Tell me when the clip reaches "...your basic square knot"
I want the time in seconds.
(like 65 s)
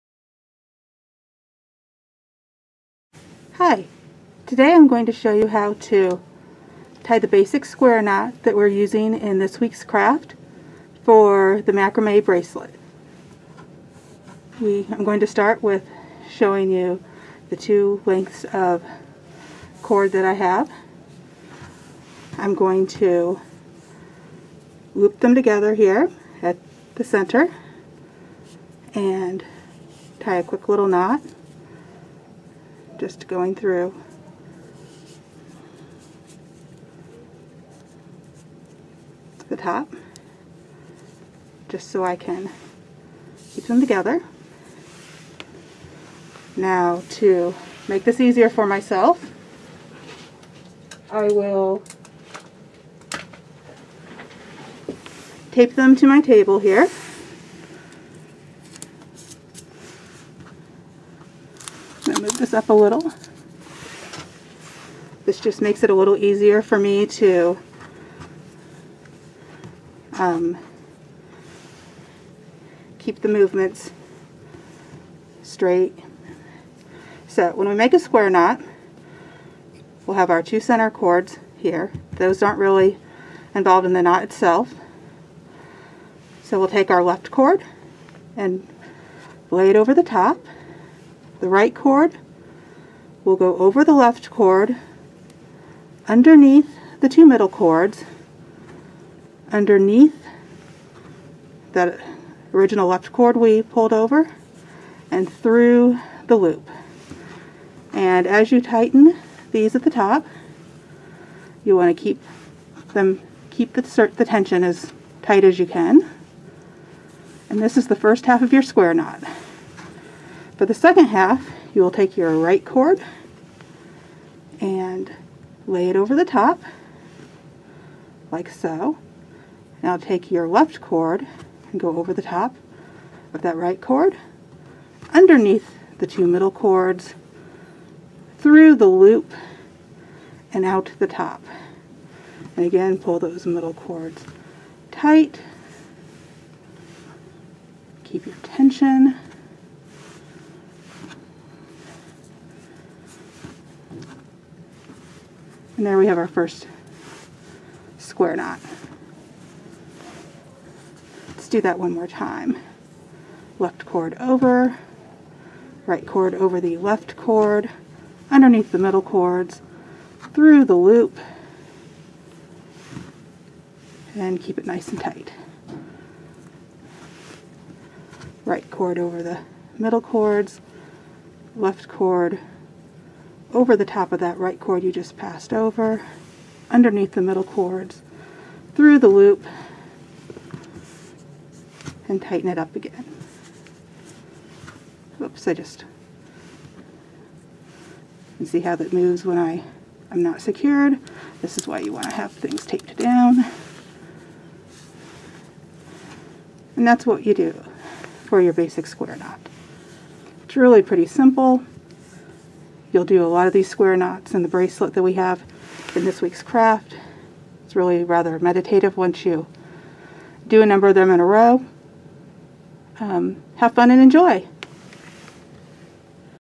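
208 s.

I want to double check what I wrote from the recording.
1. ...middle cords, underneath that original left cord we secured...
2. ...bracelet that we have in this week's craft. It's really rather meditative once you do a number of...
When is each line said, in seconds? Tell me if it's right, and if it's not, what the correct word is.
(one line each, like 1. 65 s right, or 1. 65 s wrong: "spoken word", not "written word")
1. 97 s wrong: "pulled", not "secured"
2. 214 s right.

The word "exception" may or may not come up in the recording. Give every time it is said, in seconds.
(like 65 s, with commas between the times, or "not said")
not said.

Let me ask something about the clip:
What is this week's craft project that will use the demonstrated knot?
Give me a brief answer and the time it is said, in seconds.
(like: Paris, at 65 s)
macrame bracelet, at 11 s.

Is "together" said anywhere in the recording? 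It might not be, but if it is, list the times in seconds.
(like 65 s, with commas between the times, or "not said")
25 s, 43 s.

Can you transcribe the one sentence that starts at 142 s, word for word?
And again, pull those middle cords tight.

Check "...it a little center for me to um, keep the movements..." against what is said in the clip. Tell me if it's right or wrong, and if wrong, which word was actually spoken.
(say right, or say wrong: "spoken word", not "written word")
wrong: "easier", not "center".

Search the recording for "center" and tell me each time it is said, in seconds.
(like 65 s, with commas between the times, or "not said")
27 s, 80 s.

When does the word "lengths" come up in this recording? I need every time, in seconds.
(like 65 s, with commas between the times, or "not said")
18 s.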